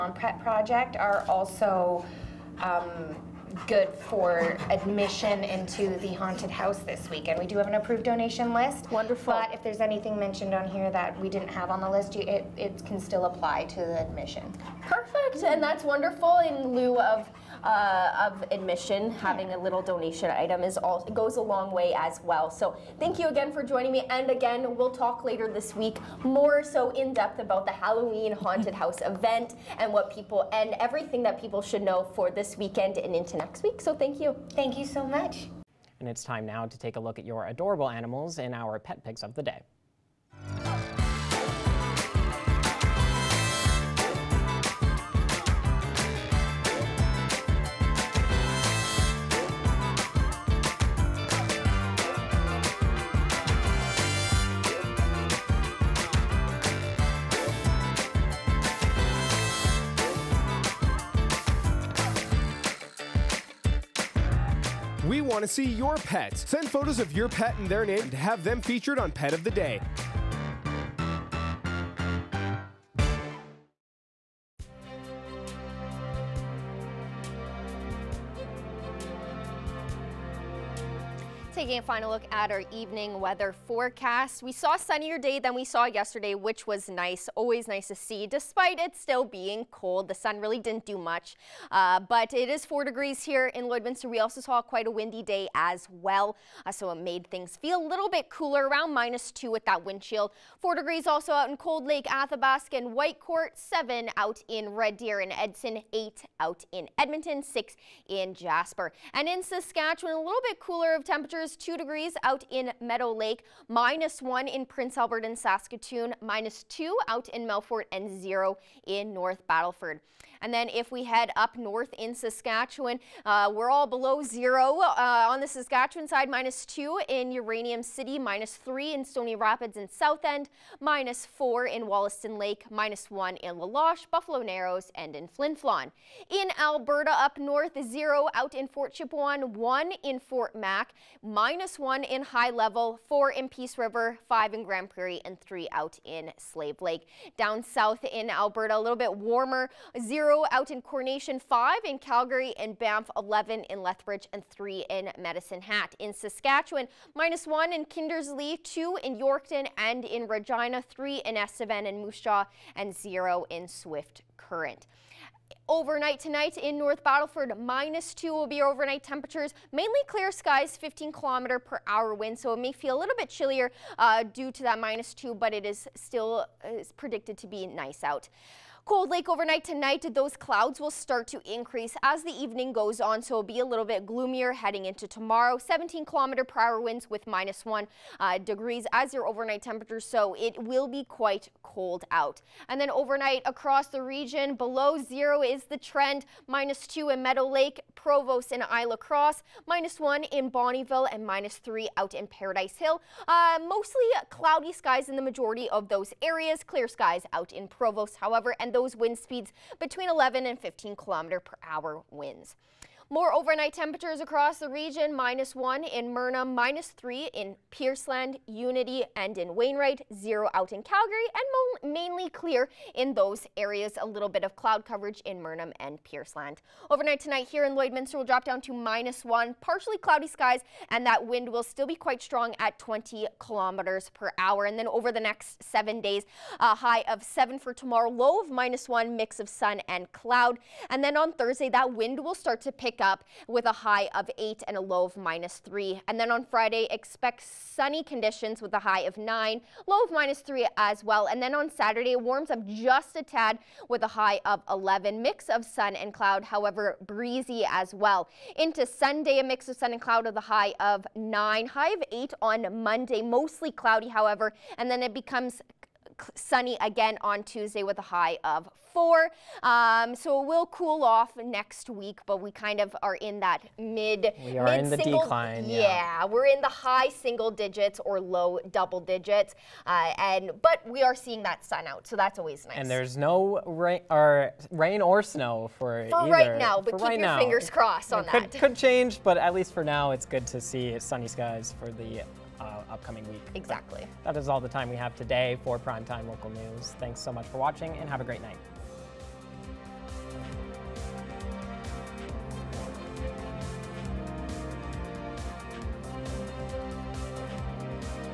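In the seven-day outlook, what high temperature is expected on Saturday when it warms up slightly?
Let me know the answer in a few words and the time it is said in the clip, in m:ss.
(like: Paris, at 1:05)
11, at 4:14.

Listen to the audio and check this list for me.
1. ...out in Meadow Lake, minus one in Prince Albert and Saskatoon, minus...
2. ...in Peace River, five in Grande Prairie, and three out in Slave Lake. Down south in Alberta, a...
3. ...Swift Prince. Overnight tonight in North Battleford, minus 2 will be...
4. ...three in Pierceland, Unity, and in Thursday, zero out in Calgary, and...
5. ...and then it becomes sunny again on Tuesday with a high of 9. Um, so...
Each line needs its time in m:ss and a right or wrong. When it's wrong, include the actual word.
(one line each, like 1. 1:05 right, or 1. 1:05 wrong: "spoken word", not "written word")
1. 1:52 right
2. 2:23 right
3. 2:43 wrong: "Current", not "Prince"
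4. 3:36 wrong: "Wainwright", not "Thursday"
5. 4:24 wrong: "4", not "9".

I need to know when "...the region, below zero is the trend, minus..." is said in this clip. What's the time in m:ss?
3:13.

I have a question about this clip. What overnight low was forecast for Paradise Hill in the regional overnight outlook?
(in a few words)
-3.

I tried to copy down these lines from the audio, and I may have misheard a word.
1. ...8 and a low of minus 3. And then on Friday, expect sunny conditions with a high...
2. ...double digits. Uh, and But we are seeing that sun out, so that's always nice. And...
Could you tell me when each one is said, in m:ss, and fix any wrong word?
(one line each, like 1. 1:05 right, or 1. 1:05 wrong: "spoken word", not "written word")
1. 4:04 right
2. 4:38 right.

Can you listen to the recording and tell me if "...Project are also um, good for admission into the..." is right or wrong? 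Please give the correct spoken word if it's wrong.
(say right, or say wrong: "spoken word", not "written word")
right.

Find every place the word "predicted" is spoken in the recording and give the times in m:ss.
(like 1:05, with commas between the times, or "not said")
2:56.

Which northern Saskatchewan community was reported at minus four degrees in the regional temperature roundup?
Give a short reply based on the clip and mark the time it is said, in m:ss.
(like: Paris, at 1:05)
Wollaston Lake, at 2:11.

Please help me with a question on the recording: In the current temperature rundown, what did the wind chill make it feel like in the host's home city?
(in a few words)
-2.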